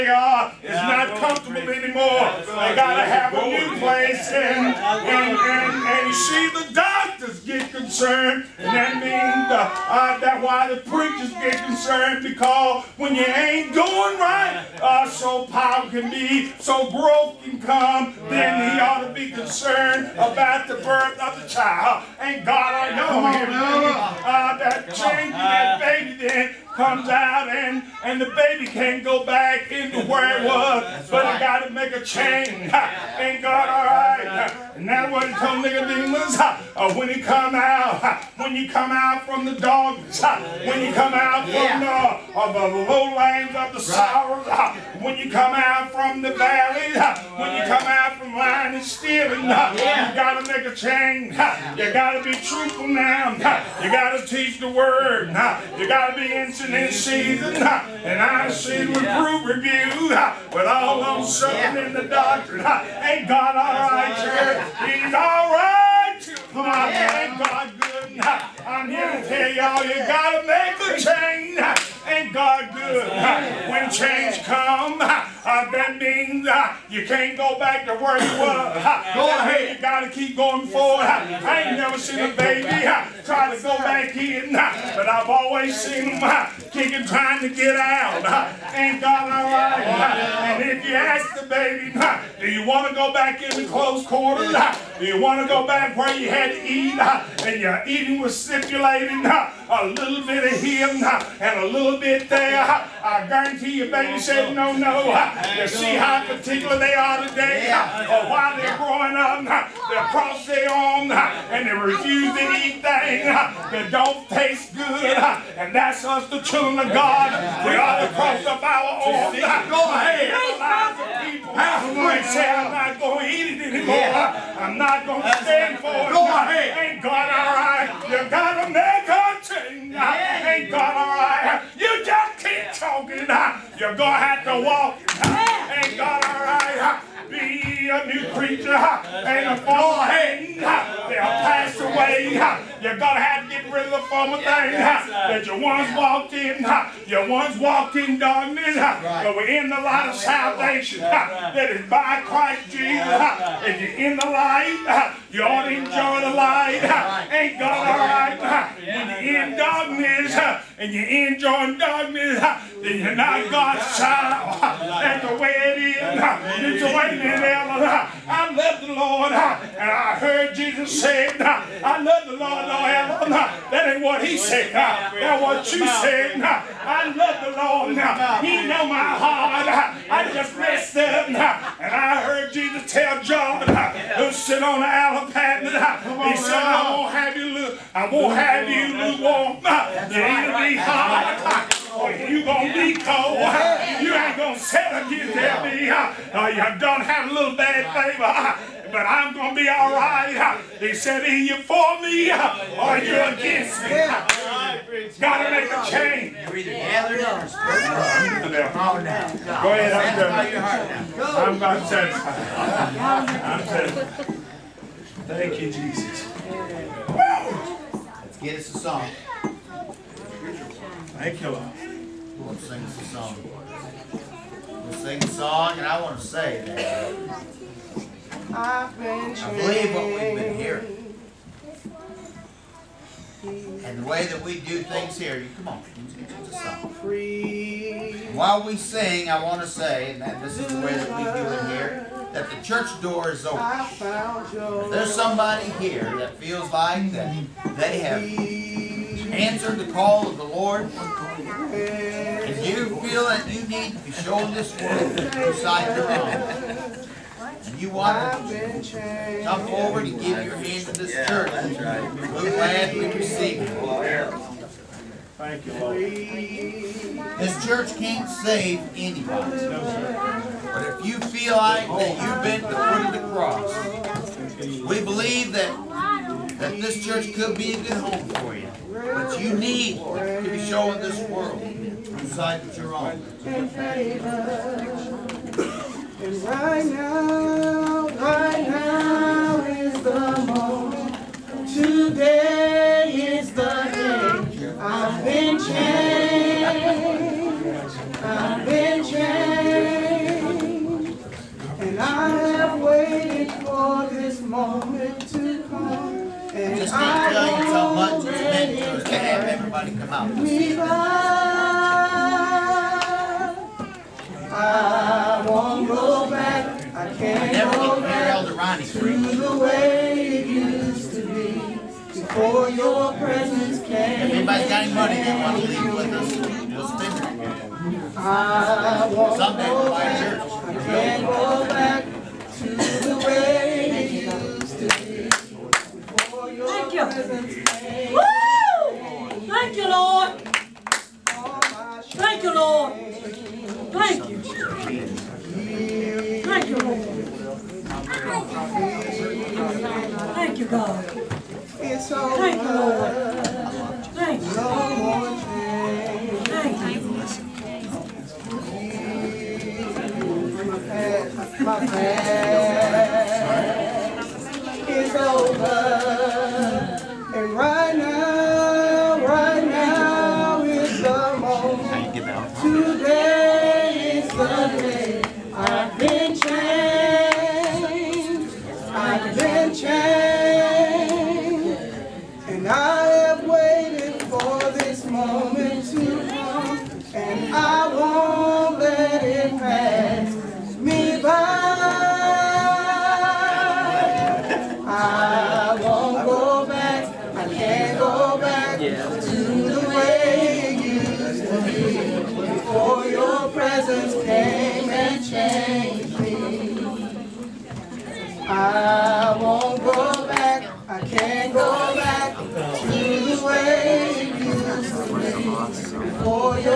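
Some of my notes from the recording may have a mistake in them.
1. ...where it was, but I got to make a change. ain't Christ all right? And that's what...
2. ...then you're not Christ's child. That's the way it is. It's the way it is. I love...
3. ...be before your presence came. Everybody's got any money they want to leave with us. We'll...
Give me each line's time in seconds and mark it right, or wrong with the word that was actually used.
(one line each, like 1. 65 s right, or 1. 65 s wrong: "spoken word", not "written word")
1. 30 s wrong: "God", not "Christ"
2. 162 s wrong: "God", not "Christ"
3. 321 s right.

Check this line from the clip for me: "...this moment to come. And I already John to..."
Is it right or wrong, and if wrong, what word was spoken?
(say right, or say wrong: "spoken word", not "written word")
wrong: "Just", not "John".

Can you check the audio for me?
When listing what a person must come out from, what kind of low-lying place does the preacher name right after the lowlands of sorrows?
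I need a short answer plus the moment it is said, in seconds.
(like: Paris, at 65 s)
the valley, at 46 s.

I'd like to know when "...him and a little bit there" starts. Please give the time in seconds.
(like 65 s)
100 s.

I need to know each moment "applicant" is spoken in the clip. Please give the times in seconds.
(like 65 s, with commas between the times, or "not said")
not said.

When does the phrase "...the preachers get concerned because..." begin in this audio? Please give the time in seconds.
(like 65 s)
10 s.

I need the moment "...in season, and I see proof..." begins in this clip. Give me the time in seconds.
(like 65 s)
56 s.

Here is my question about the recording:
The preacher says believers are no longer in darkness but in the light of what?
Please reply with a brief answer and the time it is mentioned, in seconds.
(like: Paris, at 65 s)
salvation, at 150 s.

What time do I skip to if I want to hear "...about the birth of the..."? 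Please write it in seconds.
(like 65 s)
20 s.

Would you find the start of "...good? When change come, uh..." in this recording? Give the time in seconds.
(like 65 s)
72 s.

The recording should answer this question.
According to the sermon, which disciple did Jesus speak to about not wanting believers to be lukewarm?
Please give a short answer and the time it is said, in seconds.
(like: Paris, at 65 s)
John, at 183 s.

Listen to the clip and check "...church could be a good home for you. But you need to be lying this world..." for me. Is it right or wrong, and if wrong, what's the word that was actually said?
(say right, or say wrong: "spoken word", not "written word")
wrong: "showing", not "lying".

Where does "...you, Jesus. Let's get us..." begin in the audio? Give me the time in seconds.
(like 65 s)
215 s.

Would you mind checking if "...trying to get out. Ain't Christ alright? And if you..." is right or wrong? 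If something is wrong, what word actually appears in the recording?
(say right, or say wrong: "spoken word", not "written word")
wrong: "God", not "Christ".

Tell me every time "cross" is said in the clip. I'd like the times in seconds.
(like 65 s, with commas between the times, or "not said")
110 s, 118 s, 274 s.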